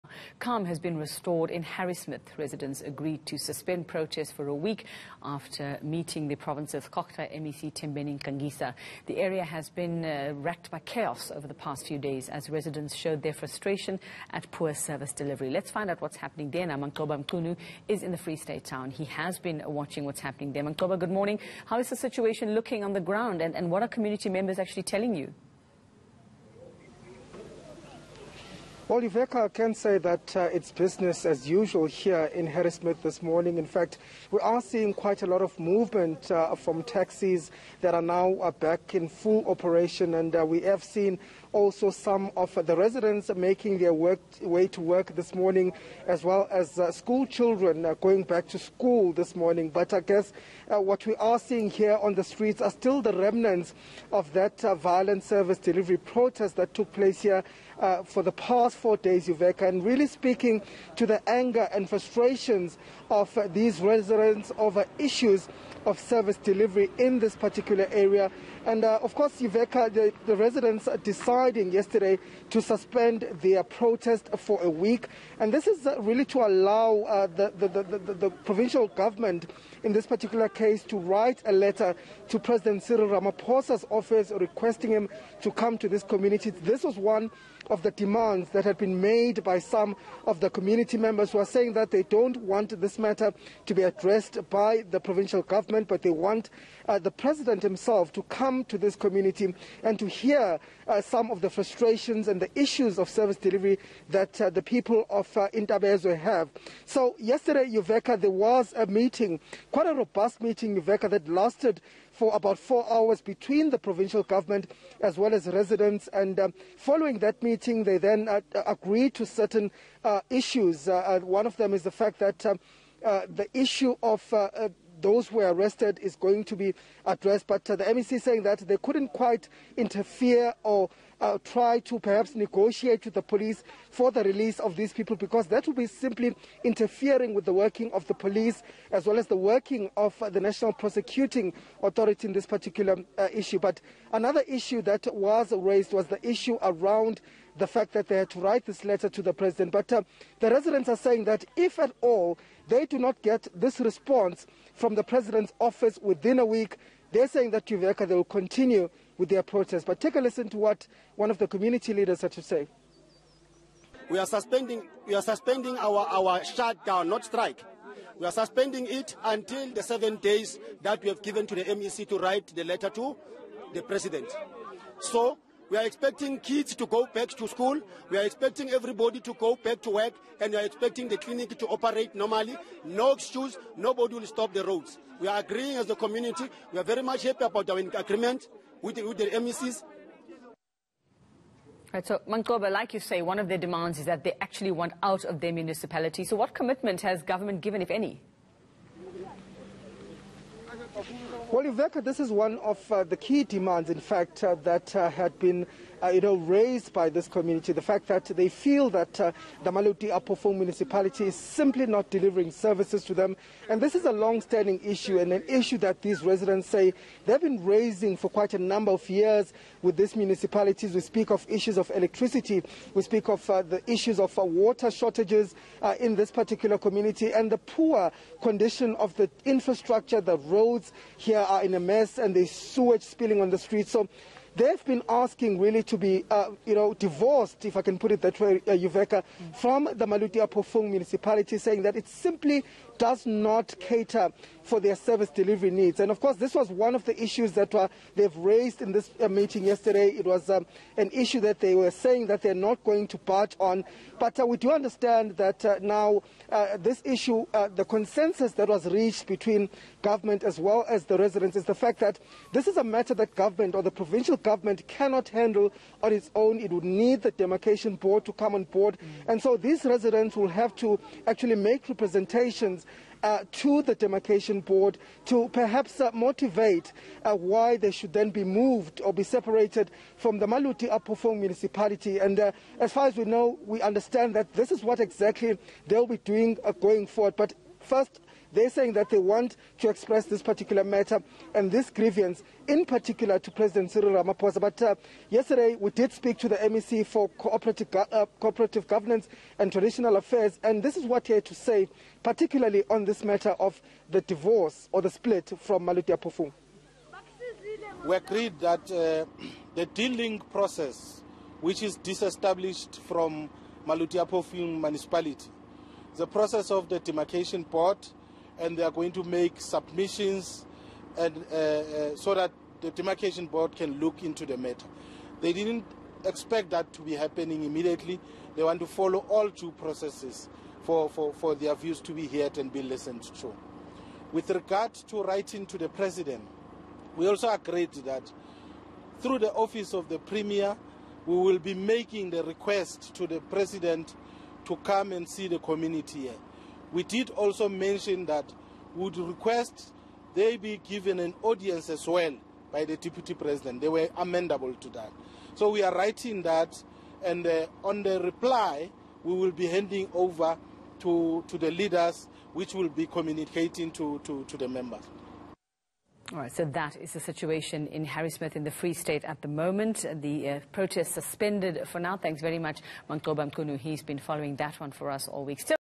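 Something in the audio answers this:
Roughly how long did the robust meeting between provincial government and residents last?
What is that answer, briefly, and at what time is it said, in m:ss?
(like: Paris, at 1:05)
About 4 hours, at 1:52.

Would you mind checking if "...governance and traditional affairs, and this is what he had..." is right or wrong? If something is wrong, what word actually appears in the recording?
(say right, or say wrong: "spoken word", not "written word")
right.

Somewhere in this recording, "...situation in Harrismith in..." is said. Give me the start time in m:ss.
6:07.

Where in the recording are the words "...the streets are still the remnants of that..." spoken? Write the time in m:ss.
0:52.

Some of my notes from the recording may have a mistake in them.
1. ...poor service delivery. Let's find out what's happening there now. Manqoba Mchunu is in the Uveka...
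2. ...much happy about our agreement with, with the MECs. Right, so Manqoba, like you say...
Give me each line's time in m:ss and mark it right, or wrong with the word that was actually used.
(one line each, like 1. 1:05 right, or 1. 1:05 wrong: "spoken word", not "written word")
1. 0:14 wrong: "Free", not "Uveka"
2. 3:07 right.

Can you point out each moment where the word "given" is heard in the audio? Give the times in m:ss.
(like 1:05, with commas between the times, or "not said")
2:51, 3:17, 5:50.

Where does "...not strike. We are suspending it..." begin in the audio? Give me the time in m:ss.
2:47.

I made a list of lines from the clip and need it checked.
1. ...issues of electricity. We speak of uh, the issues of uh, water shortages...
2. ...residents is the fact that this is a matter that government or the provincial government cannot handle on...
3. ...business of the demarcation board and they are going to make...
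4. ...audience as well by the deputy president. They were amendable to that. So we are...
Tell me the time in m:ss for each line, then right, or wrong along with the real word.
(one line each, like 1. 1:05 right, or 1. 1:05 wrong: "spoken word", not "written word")
1. 3:41 right
2. 4:21 right
3. 5:16 wrong: "process", not "business"
4. 5:51 right.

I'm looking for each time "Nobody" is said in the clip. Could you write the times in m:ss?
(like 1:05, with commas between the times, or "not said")
3:03.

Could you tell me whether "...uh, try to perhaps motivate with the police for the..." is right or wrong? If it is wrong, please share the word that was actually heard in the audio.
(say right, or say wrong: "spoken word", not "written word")
wrong: "negotiate", not "motivate".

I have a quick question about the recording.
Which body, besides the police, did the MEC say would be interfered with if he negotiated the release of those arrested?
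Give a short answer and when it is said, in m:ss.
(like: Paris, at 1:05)
National Prosecuting Authority, at 2:20.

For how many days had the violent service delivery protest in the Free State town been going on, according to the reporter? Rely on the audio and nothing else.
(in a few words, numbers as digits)
4 days.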